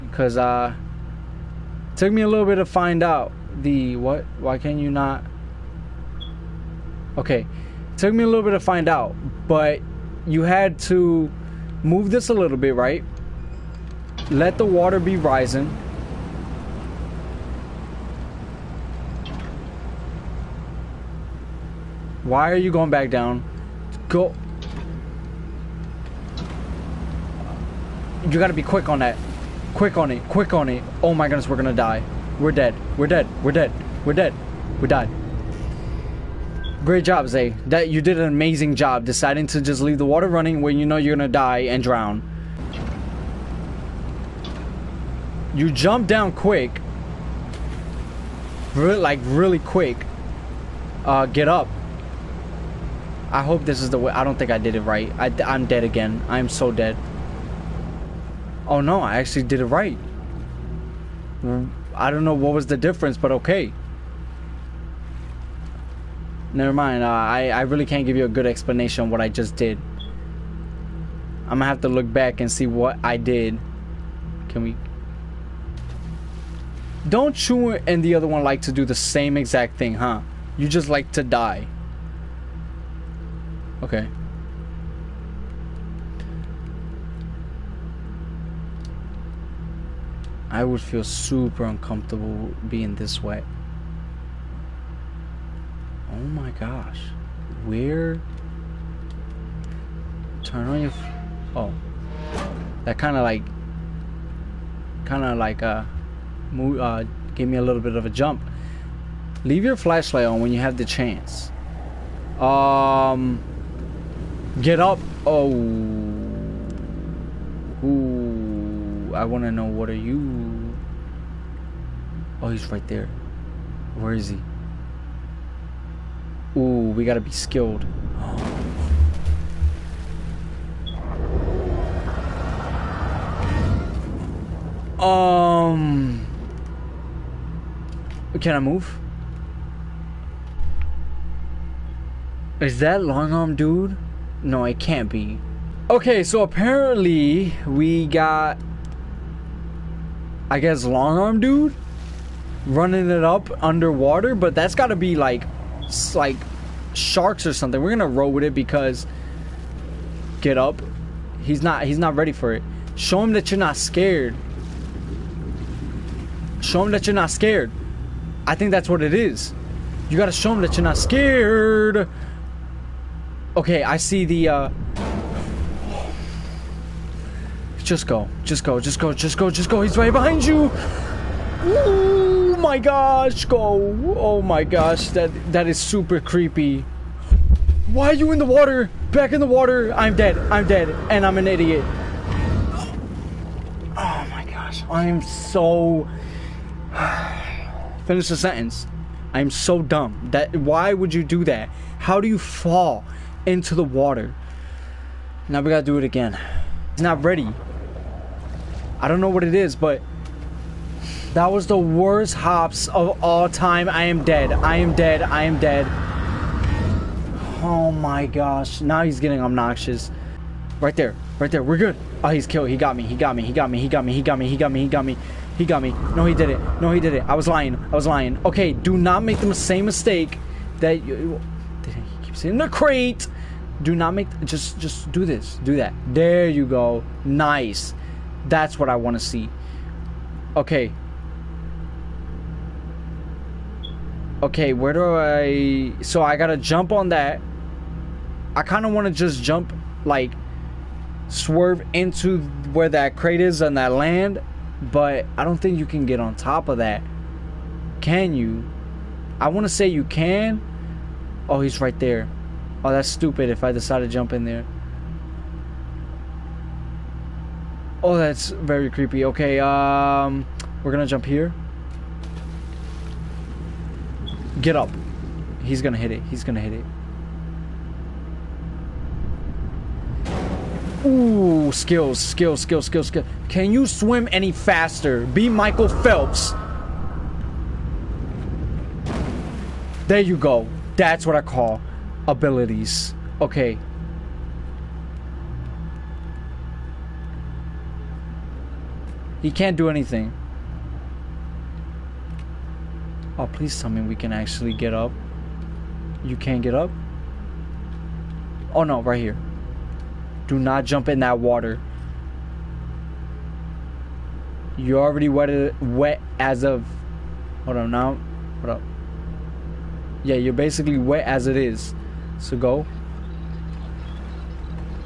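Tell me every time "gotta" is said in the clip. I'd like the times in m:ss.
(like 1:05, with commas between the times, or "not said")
0:28, 2:07, 2:50, 3:25, 4:06.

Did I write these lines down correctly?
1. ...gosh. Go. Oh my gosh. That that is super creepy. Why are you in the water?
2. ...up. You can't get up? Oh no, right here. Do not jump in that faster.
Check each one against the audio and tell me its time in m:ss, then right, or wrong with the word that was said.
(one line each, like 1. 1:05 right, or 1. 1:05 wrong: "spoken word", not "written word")
1. 3:02 right
2. 5:04 wrong: "water", not "faster".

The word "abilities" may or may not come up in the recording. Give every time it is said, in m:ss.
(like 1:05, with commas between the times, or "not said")
4:52.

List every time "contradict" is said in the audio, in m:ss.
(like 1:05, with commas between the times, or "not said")
not said.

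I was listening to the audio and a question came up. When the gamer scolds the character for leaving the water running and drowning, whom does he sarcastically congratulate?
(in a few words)
Zay.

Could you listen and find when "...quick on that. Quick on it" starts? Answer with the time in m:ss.
0:28.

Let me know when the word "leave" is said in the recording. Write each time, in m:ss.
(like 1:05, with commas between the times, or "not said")
0:39, 1:49.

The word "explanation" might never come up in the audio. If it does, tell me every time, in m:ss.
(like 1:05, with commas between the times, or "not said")
1:08.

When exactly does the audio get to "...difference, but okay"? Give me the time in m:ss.
1:02.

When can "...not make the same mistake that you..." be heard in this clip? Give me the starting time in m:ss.
3:48.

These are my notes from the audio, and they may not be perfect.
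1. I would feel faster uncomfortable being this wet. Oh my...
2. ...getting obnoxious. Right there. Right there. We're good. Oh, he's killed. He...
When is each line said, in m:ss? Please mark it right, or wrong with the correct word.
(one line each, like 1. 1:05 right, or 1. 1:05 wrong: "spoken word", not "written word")
1. 1:30 wrong: "super", not "faster"
2. 3:39 right.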